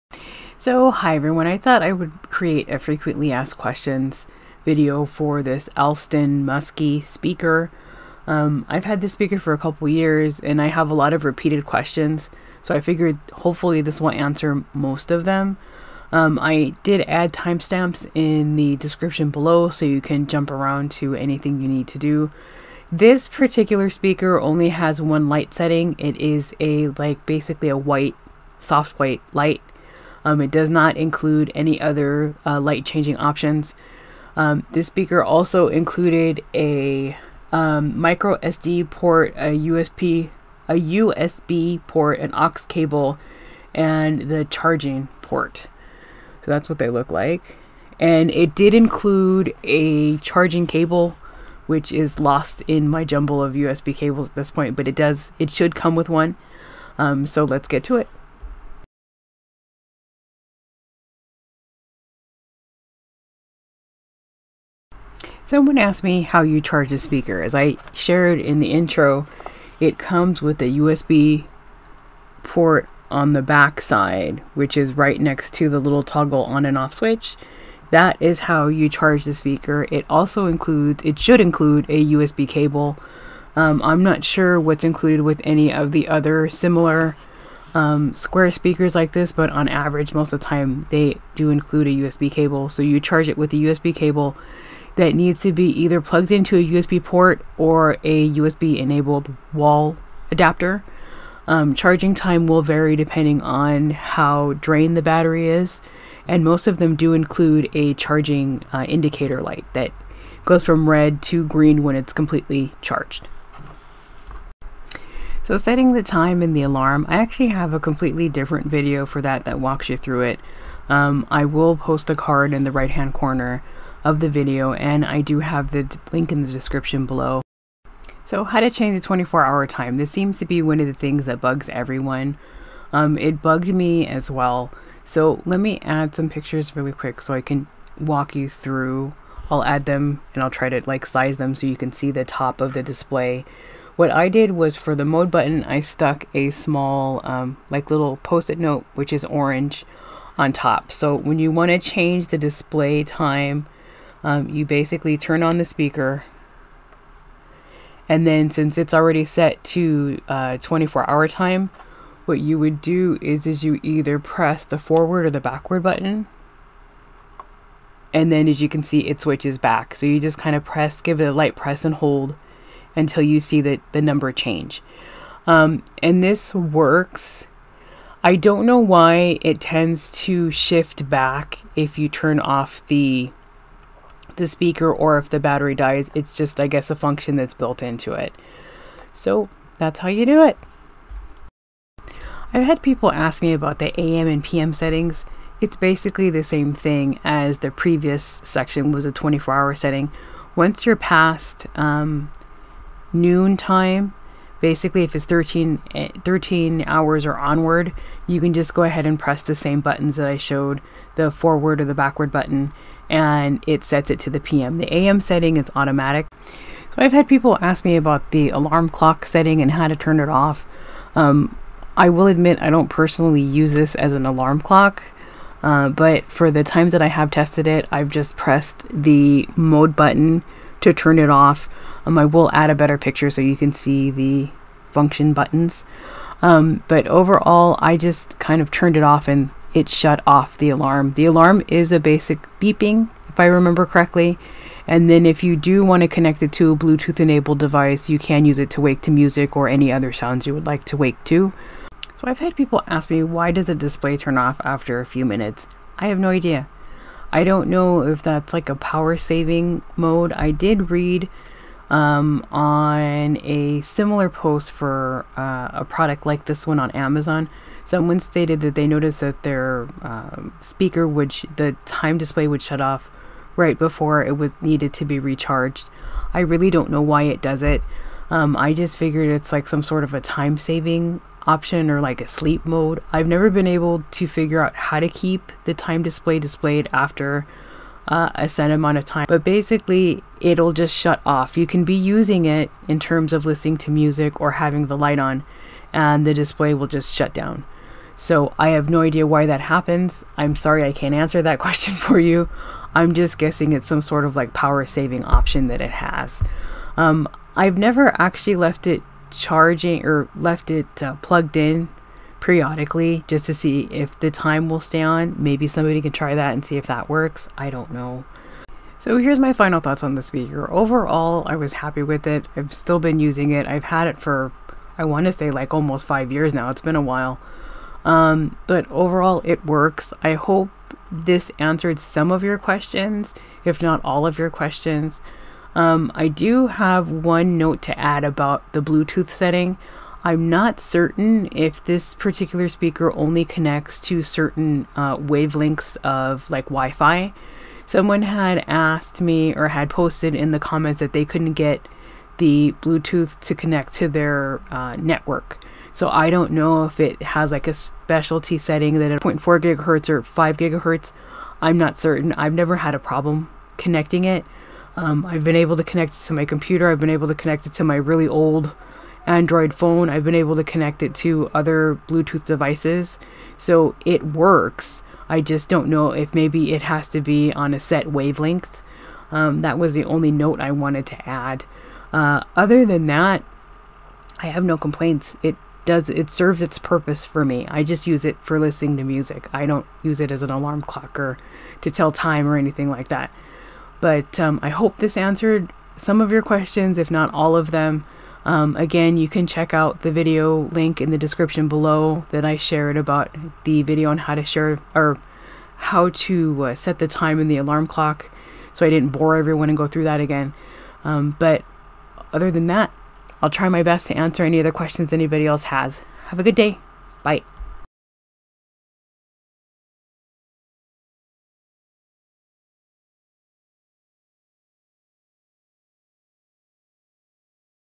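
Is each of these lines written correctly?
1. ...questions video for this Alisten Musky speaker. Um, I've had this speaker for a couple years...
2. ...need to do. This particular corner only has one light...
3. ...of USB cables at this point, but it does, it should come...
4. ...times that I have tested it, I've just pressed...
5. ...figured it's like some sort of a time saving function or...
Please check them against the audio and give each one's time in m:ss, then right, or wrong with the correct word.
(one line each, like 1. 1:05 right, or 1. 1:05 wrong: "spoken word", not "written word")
1. 0:03 right
2. 0:21 wrong: "speaker", not "corner"
3. 0:53 right
4. 3:46 right
5. 4:38 wrong: "option", not "function".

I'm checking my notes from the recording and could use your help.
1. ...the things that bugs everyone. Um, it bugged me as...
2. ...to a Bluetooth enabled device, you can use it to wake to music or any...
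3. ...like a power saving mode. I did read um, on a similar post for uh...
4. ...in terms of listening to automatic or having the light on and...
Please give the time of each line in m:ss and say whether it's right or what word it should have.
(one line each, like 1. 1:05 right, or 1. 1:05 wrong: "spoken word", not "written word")
1. 2:10 right
2. 4:06 right
3. 4:18 right
4. 4:52 wrong: "music", not "automatic".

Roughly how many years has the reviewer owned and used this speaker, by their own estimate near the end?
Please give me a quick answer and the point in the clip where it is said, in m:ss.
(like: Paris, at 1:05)
almost 5 years, at 5:25.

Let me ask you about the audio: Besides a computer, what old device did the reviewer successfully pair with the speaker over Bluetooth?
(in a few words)
Android phone.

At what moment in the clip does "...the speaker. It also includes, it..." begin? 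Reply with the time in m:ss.
1:19.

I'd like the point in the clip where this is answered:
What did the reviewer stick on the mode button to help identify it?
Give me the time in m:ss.
2:28.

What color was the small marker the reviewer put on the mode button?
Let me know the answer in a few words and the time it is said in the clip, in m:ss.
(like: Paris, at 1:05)
orange, at 2:29.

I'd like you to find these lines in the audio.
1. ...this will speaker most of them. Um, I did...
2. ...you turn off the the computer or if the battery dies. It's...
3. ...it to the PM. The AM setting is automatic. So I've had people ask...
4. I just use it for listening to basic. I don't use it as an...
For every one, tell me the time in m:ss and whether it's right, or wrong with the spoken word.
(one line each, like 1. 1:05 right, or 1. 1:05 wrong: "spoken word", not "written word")
1. 0:13 wrong: "answer", not "speaker"
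2. 3:01 wrong: "speaker", not "computer"
3. 3:34 right
4. 6:27 wrong: "music", not "basic".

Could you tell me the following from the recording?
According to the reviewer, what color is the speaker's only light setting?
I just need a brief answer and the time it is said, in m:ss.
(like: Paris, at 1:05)
soft white, at 0:28.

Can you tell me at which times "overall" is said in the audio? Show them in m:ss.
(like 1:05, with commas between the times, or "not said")
3:57, 5:20, 5:28.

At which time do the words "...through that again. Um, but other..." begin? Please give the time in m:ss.
6:49.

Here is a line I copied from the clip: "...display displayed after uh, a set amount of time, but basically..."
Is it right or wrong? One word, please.
right.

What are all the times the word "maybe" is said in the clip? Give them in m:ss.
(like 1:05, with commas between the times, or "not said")
5:15, 6:16.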